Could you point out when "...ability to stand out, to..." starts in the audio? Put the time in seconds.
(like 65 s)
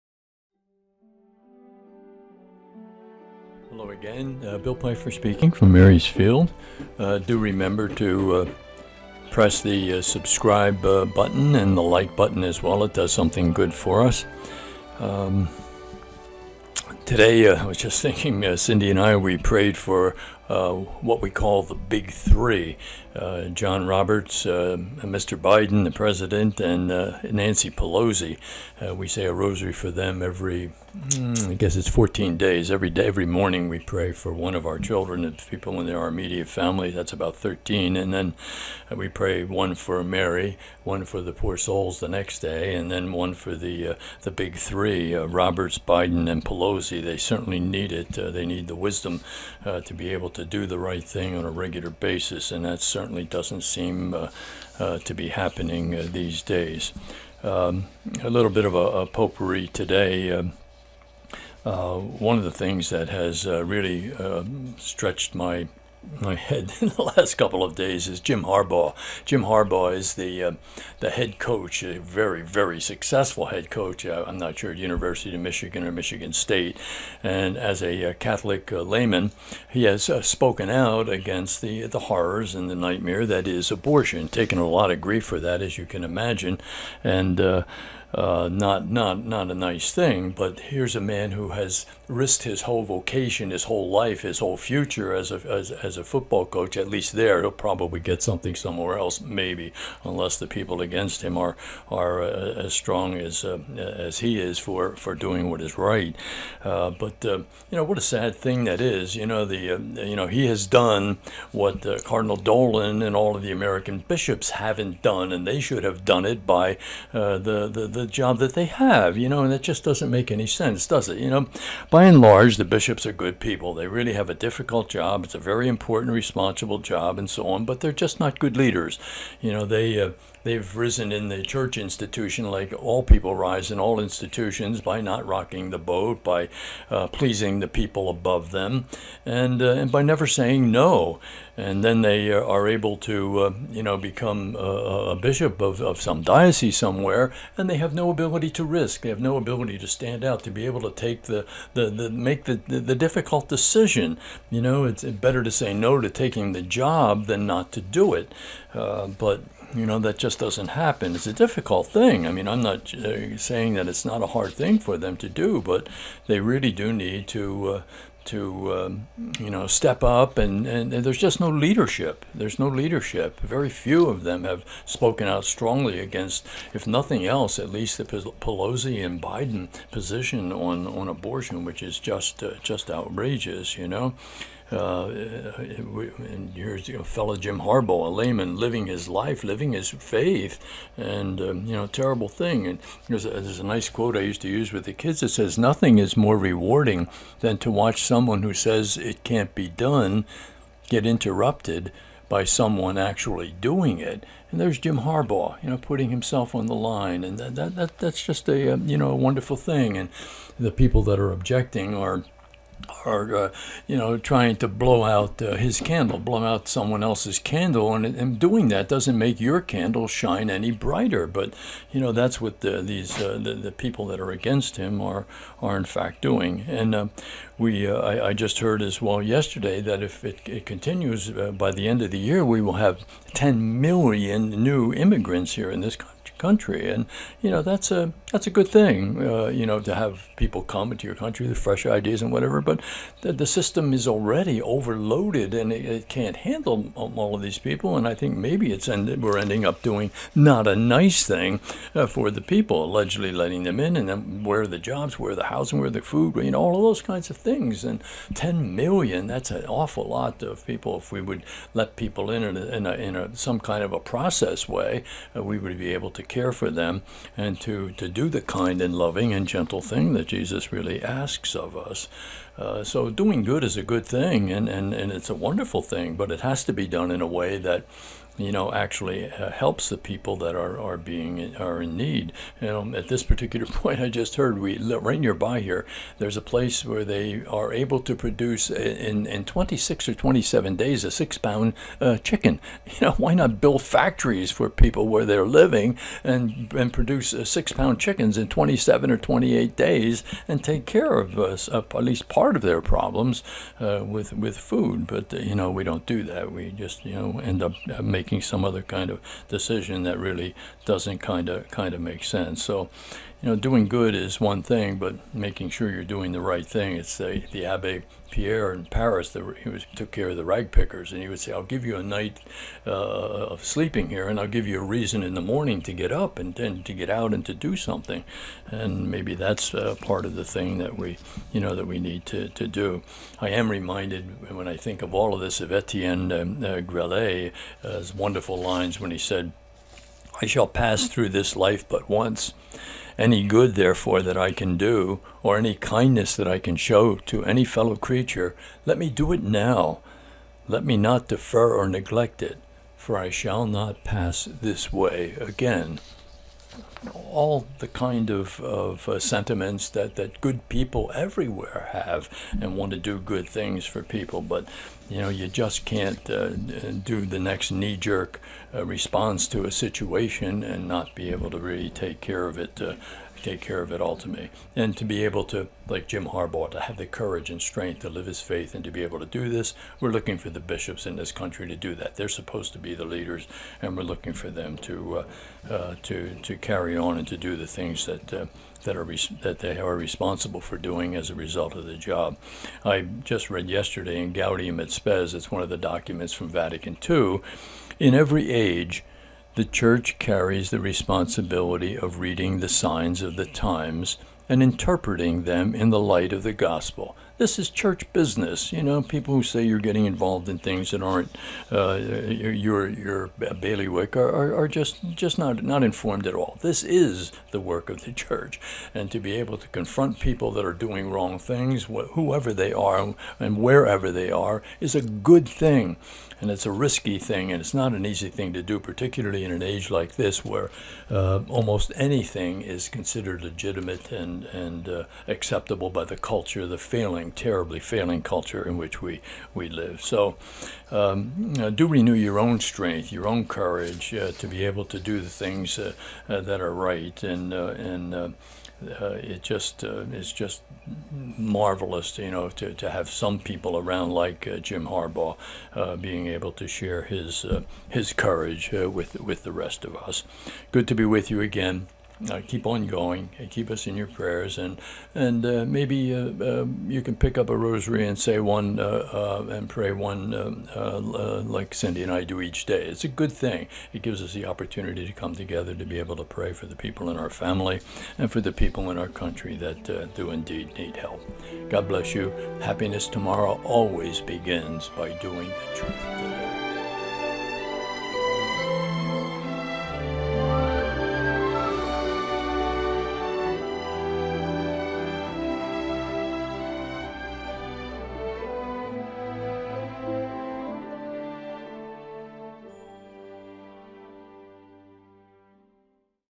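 149 s.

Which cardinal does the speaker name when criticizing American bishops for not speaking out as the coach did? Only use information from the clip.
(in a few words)
Cardinal Dolan.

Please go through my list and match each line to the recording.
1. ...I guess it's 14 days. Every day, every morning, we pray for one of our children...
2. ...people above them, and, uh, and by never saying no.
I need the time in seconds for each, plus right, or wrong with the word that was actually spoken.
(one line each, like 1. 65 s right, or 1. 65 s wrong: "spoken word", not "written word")
1. 31 s right
2. 137 s right.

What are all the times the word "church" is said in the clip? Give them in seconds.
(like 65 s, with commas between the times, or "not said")
131 s, 399 s, 407 s, 418 s.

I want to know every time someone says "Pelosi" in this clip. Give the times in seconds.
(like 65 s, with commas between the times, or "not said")
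27 s, 46 s, 178 s.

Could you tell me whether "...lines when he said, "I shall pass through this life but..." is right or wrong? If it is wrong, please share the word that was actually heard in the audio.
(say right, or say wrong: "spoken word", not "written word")
right.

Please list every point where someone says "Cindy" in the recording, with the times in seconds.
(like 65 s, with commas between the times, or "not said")
18 s, 471 s.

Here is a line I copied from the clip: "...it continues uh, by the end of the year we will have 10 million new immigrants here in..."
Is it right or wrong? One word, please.
right.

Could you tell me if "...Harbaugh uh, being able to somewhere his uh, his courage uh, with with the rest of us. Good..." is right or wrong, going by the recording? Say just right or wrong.
wrong.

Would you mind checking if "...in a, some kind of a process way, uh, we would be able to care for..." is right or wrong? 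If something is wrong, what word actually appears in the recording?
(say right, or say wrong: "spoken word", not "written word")
right.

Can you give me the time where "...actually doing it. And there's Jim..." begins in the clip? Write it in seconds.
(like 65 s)
202 s.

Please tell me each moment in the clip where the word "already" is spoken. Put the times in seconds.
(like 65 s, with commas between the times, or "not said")
244 s.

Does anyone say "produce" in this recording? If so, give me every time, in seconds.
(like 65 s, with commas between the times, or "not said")
288 s, 296 s.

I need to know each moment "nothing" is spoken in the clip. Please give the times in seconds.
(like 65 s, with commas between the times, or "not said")
176 s, 195 s.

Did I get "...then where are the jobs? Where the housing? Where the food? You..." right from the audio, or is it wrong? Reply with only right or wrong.
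right.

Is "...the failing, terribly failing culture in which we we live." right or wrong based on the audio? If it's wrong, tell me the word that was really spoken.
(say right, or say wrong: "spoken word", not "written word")
right.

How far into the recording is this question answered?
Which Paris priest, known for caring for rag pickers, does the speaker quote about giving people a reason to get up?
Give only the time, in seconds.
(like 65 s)
317 s.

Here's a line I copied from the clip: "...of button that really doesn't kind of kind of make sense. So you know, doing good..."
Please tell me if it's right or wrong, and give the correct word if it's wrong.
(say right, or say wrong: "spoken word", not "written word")
wrong: "decision", not "button".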